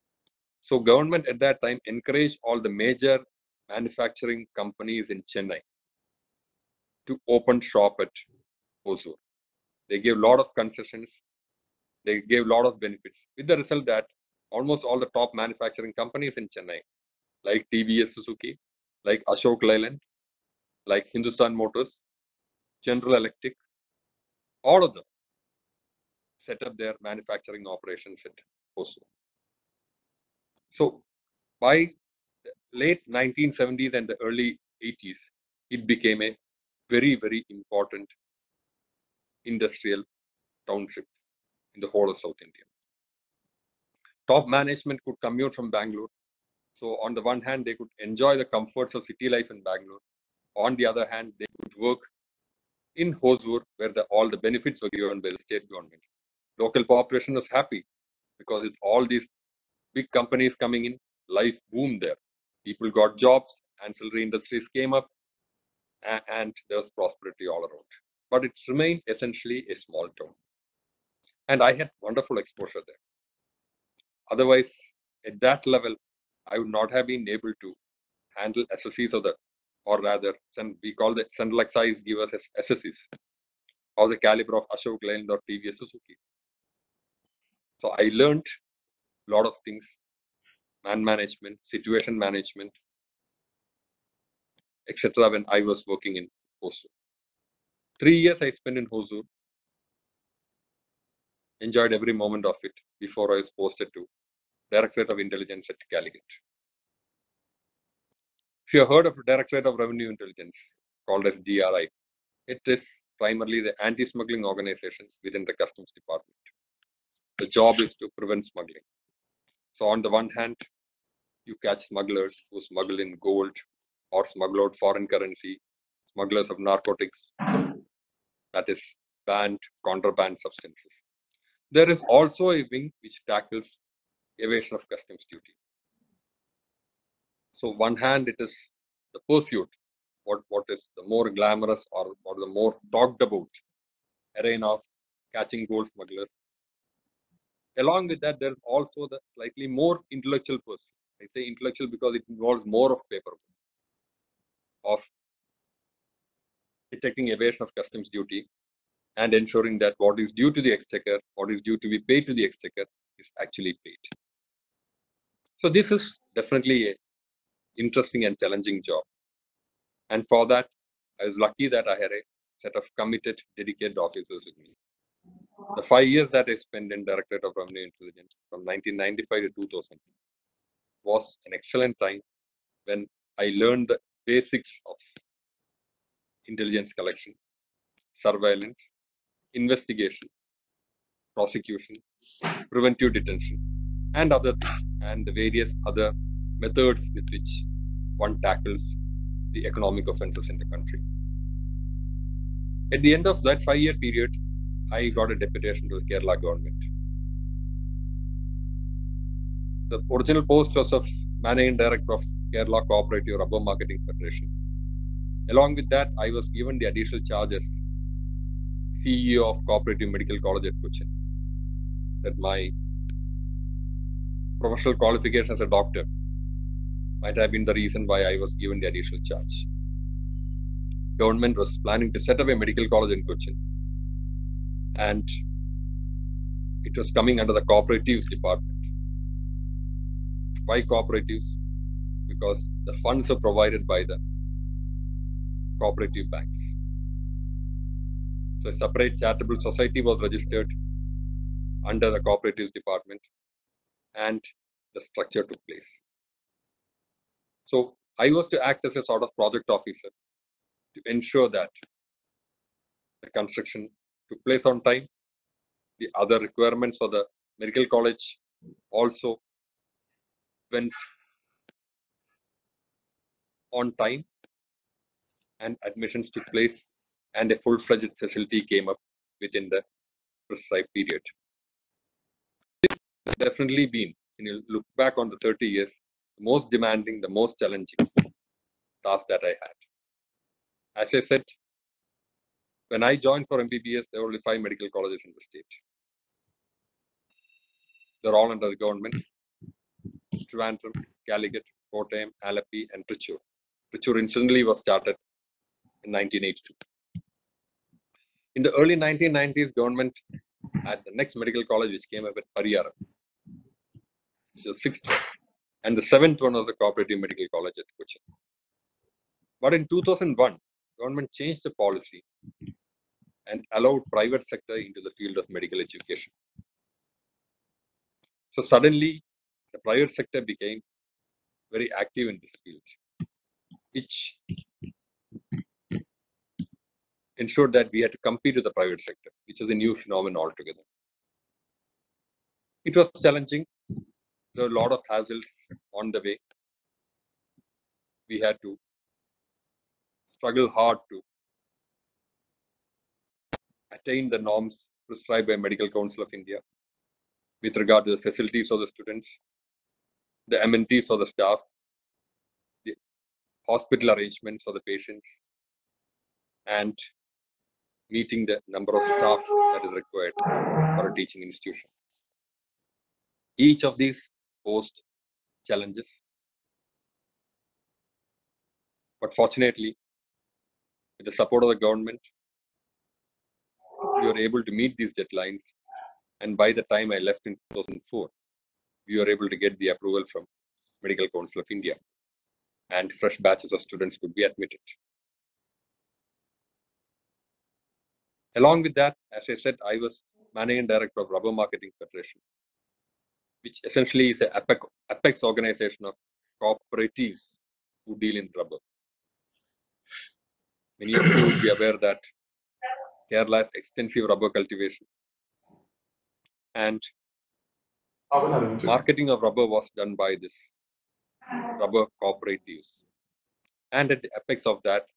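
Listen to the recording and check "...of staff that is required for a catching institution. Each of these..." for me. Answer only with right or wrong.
wrong.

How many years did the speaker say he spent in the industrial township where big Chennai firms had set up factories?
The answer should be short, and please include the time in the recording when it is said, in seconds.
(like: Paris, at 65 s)
3, at 97 s.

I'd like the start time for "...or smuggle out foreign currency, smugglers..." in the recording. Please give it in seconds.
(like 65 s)
124 s.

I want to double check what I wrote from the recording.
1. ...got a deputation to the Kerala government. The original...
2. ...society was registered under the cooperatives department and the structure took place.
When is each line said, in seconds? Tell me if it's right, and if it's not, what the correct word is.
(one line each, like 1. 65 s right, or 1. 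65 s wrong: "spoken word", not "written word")
1. 205 s right
2. 249 s right.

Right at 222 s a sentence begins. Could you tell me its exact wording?
That my professional qualification as a doctor might have been the reason why I was given the additional charge.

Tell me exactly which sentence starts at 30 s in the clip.
So by late 1970s and the early 80s, it became a very, very important industrial township in the whole of South India.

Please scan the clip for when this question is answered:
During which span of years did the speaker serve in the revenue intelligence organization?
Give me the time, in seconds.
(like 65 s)
178 s.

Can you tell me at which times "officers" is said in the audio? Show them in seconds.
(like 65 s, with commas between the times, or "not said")
173 s, 259 s.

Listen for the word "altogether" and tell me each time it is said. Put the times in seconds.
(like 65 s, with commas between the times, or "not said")
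340 s.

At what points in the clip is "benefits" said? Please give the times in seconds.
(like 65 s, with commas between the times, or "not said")
12 s, 54 s.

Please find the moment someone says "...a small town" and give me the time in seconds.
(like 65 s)
69 s.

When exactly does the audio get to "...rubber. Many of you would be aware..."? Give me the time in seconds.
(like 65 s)
408 s.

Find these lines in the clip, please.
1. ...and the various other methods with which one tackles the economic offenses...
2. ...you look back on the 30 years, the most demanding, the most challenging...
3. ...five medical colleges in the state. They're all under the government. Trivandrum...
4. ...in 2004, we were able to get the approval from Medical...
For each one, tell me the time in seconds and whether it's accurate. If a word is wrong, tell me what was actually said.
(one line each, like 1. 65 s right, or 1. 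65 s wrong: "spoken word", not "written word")
1. 195 s right
2. 284 s right
3. 294 s right
4. 387 s right.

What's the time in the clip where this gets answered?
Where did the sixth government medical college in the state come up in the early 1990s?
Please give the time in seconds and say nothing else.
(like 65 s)
312 s.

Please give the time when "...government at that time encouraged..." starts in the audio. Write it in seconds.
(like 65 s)
0 s.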